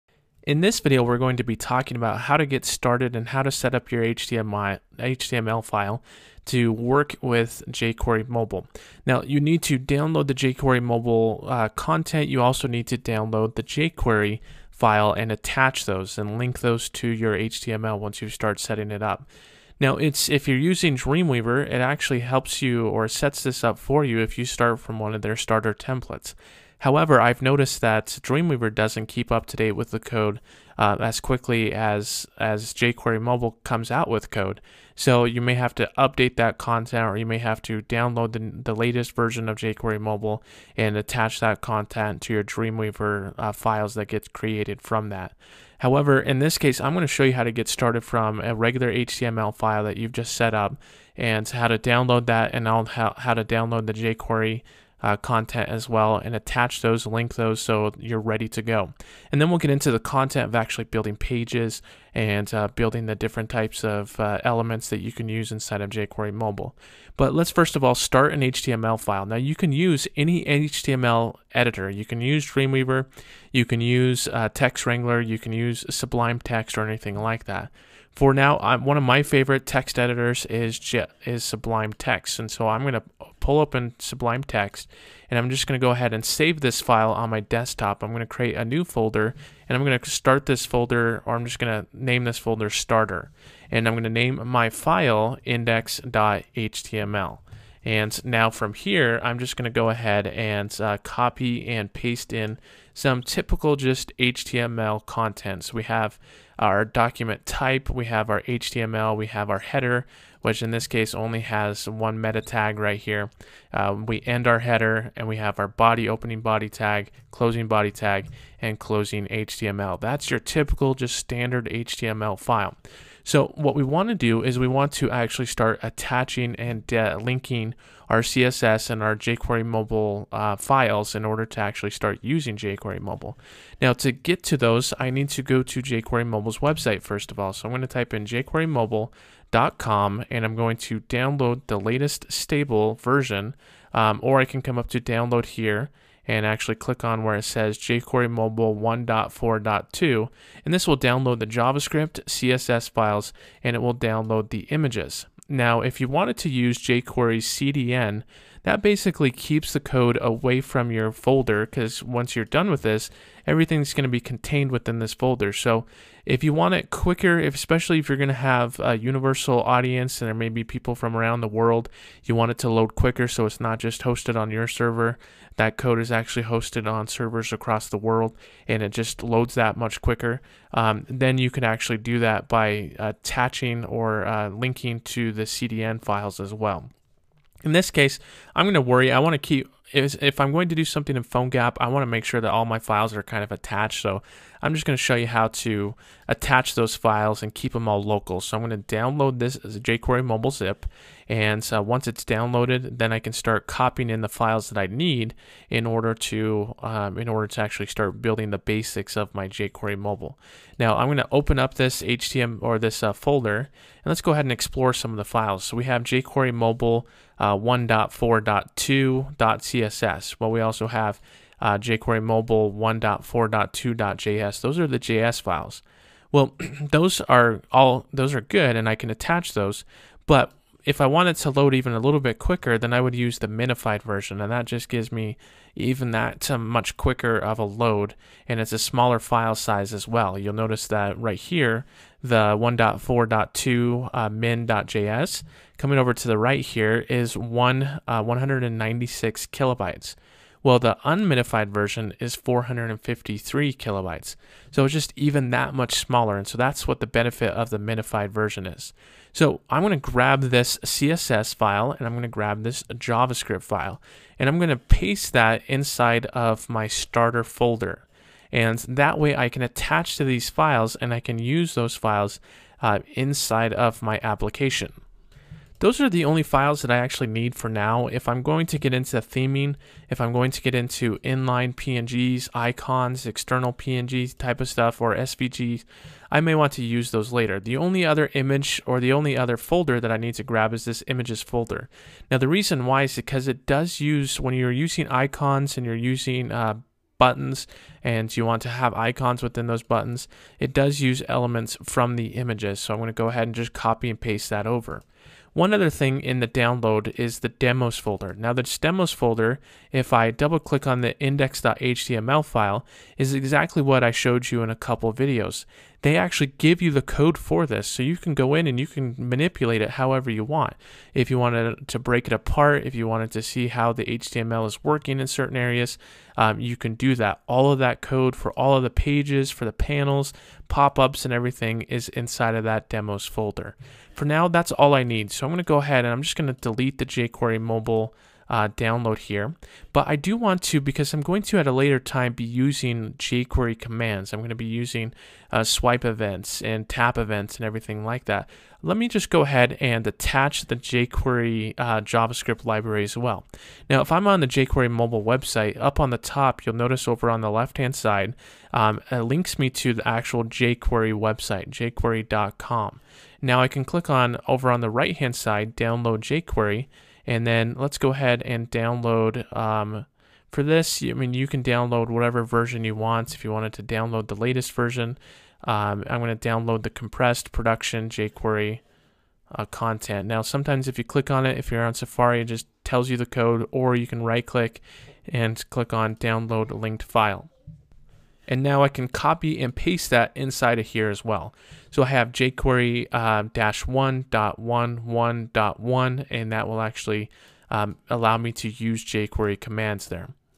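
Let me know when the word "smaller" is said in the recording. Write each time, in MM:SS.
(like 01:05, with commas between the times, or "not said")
03:58, 04:15.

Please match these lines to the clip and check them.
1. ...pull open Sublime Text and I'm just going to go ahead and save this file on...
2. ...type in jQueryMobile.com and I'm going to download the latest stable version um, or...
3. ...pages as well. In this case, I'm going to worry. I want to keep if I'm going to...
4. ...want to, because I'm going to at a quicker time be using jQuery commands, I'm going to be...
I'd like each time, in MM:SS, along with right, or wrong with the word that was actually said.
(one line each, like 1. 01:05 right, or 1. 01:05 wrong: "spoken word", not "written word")
1. 01:23 right
2. 02:17 right
3. 03:06 wrong: "files", not "pages"
4. 05:40 wrong: "later", not "quicker".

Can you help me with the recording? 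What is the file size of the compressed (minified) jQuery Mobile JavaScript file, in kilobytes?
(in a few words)
196 kilobytes.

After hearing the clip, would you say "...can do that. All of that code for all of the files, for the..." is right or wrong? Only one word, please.
wrong.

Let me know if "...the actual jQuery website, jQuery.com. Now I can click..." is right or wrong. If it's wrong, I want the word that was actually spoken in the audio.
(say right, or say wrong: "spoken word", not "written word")
right.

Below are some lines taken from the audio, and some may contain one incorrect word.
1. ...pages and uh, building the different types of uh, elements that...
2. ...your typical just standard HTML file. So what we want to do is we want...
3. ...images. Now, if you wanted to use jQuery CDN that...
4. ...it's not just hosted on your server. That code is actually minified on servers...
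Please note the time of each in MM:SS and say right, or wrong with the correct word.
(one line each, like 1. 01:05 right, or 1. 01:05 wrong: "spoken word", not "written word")
1. 01:01 right
2. 02:00 right
3. 02:34 right
4. 02:53 wrong: "hosted", not "minified".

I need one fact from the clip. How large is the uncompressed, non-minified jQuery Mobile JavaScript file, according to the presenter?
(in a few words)
453 kilobytes.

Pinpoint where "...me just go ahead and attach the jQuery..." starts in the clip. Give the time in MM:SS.
05:48.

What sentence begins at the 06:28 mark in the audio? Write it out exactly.
And now I can copy and paste that inside of here as well.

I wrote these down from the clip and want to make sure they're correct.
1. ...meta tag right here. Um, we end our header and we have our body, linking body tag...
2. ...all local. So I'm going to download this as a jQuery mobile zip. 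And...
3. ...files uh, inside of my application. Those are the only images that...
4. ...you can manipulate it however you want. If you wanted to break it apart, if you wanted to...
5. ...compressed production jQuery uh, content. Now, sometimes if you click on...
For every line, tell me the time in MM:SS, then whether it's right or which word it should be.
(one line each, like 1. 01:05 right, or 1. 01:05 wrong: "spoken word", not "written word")
1. 01:52 wrong: "opening", not "linking"
2. 03:17 right
3. 04:31 wrong: "files", not "images"
4. 05:18 right
5. 06:16 right.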